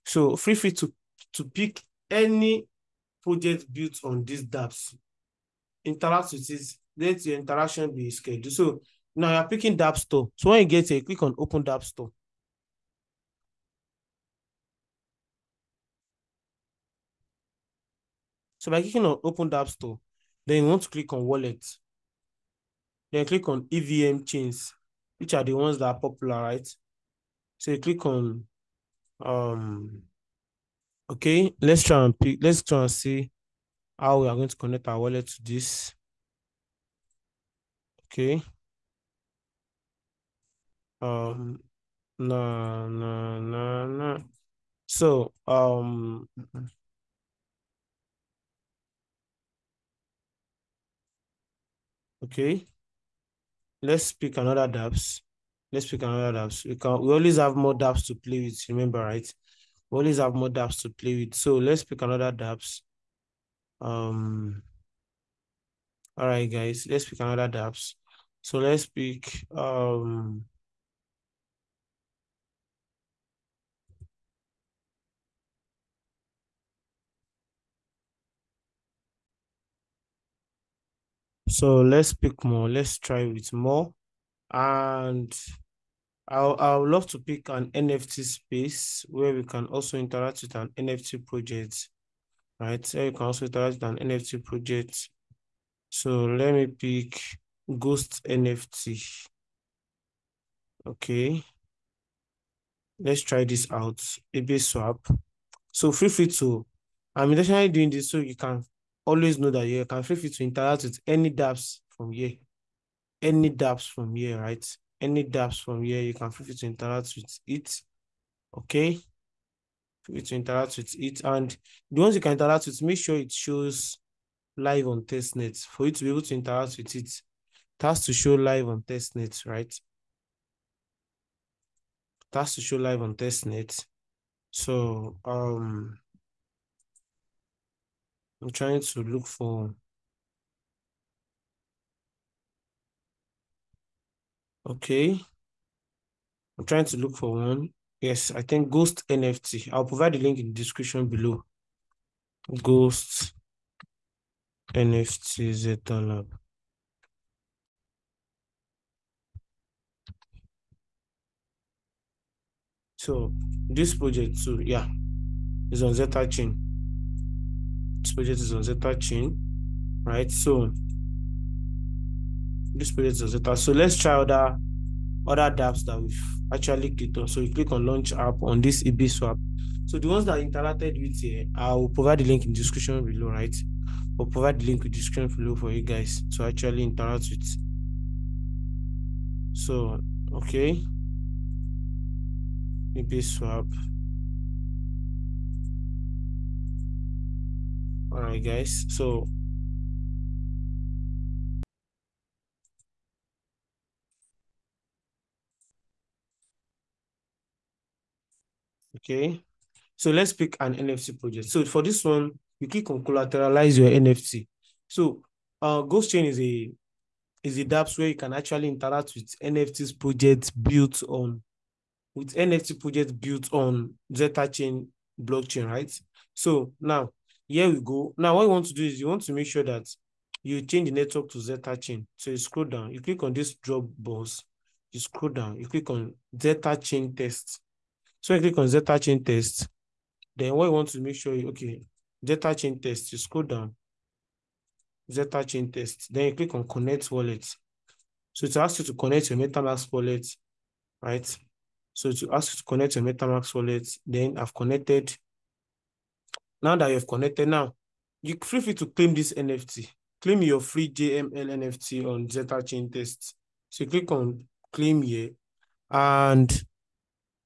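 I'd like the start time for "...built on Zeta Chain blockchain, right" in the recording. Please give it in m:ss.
3:43.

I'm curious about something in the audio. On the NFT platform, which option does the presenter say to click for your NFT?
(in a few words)
collateralize your NFT.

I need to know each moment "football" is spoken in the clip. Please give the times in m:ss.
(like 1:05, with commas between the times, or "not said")
not said.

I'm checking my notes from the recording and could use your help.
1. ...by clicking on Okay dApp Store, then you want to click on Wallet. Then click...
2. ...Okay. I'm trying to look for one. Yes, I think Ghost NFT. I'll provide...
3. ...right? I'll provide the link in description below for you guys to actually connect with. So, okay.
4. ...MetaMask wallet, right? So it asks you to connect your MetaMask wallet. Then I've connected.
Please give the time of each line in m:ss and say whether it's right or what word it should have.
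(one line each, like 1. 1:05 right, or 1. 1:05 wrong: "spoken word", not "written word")
1. 0:18 wrong: "Open", not "Okay"
2. 2:24 right
3. 3:03 wrong: "interact", not "connect"
4. 4:09 right.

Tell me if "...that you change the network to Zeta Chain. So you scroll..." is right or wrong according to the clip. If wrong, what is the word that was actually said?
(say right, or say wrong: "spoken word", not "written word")
right.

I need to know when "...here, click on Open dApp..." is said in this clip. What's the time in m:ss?
0:10.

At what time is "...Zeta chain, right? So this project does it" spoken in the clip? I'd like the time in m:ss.
2:48.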